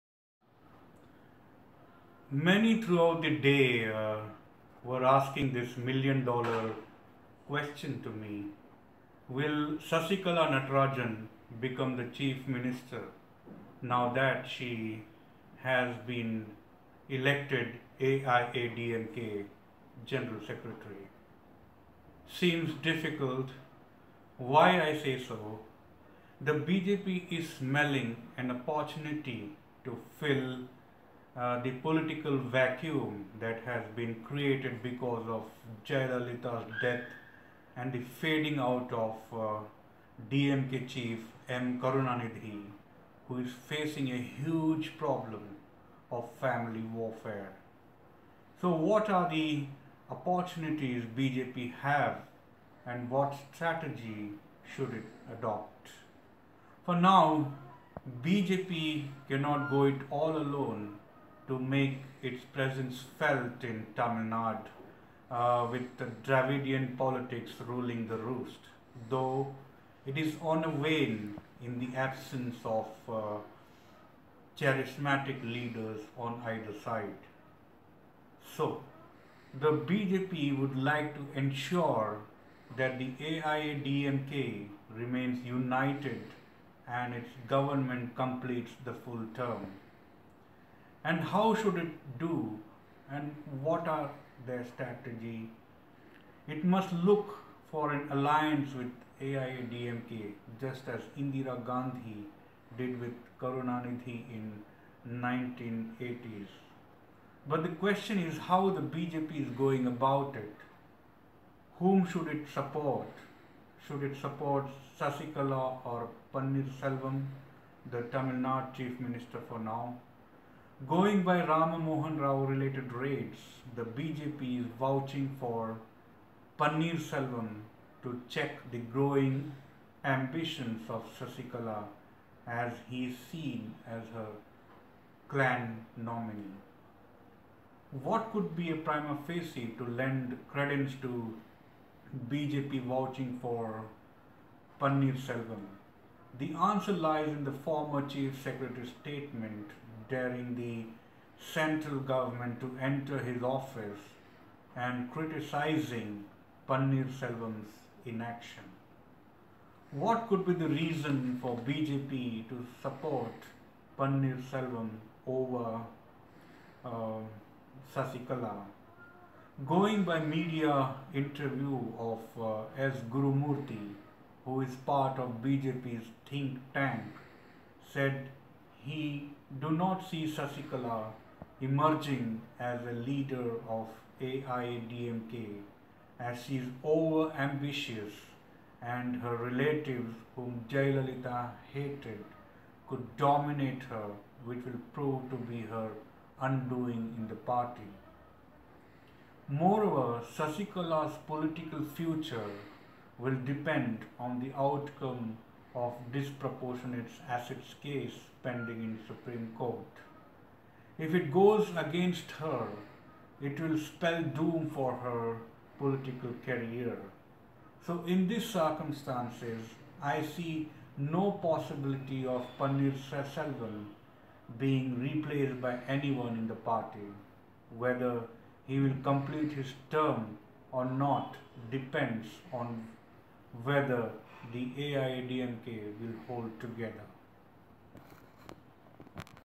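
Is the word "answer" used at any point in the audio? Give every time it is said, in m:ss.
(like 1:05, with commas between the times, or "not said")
2:26.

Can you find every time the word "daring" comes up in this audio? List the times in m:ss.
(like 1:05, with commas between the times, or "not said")
2:30.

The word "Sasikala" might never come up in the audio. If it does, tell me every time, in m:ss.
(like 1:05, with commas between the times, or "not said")
0:09, 1:54, 2:11, 2:47, 3:00, 3:20.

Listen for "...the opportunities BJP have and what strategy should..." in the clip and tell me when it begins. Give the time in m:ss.
0:49.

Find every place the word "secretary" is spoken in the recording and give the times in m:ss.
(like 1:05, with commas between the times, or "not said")
0:20, 2:28.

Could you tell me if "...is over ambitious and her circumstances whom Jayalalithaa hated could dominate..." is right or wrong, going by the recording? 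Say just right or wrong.
wrong.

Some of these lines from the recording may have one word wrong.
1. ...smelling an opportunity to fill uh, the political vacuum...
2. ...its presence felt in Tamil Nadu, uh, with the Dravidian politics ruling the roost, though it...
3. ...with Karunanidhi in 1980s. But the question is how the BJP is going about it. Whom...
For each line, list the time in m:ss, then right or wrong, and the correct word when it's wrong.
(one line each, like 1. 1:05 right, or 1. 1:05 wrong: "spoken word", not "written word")
1. 0:27 right
2. 1:02 right
3. 1:42 right.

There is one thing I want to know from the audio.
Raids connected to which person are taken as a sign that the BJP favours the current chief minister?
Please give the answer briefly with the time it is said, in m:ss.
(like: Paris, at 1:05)
Rama Mohan Rao, at 2:01.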